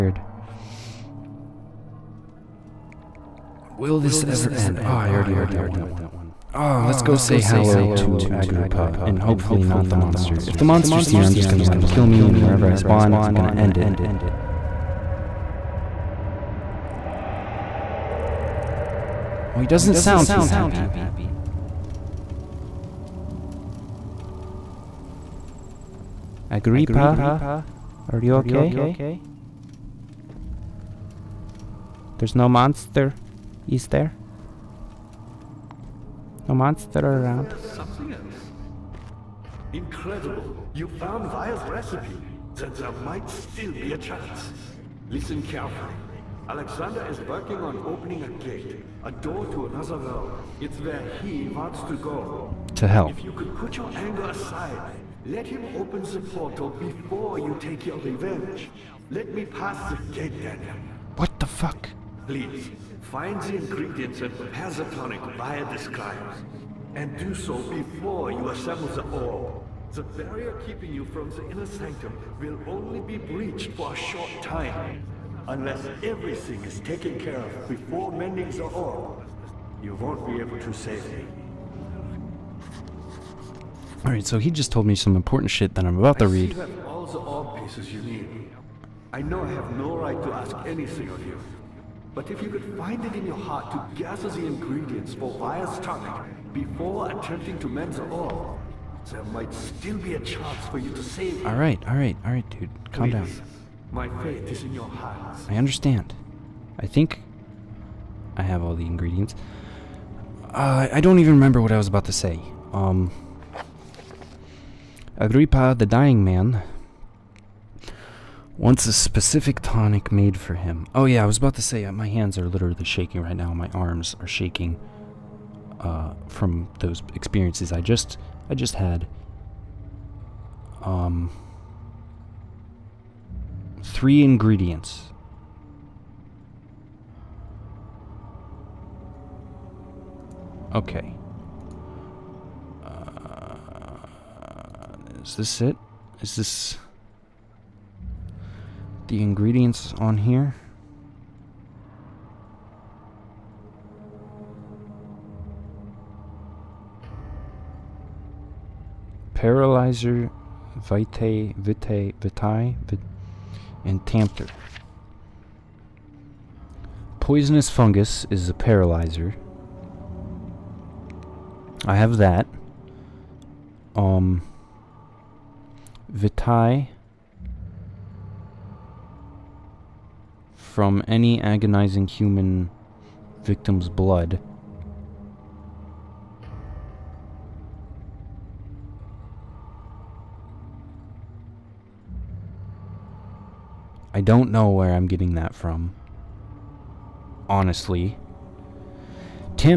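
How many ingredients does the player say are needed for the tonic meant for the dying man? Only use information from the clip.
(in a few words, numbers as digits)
3.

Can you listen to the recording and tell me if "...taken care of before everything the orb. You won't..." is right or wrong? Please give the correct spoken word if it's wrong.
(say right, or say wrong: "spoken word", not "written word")
wrong: "mending", not "everything".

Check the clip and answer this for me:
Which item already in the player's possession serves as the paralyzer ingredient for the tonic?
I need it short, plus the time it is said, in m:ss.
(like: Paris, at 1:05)
Poisonous Fungus, at 2:47.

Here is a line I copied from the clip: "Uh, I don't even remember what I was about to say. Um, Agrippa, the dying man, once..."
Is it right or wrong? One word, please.
right.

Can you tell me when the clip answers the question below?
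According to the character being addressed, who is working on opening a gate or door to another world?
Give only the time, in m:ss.
0:46.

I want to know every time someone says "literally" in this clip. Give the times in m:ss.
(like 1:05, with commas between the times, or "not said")
2:02.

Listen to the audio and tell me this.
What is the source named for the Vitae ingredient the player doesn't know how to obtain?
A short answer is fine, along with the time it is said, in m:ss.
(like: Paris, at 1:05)
Agonizing human victim's blood, at 3:01.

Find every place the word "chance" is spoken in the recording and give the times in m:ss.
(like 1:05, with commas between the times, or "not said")
0:43, 1:40.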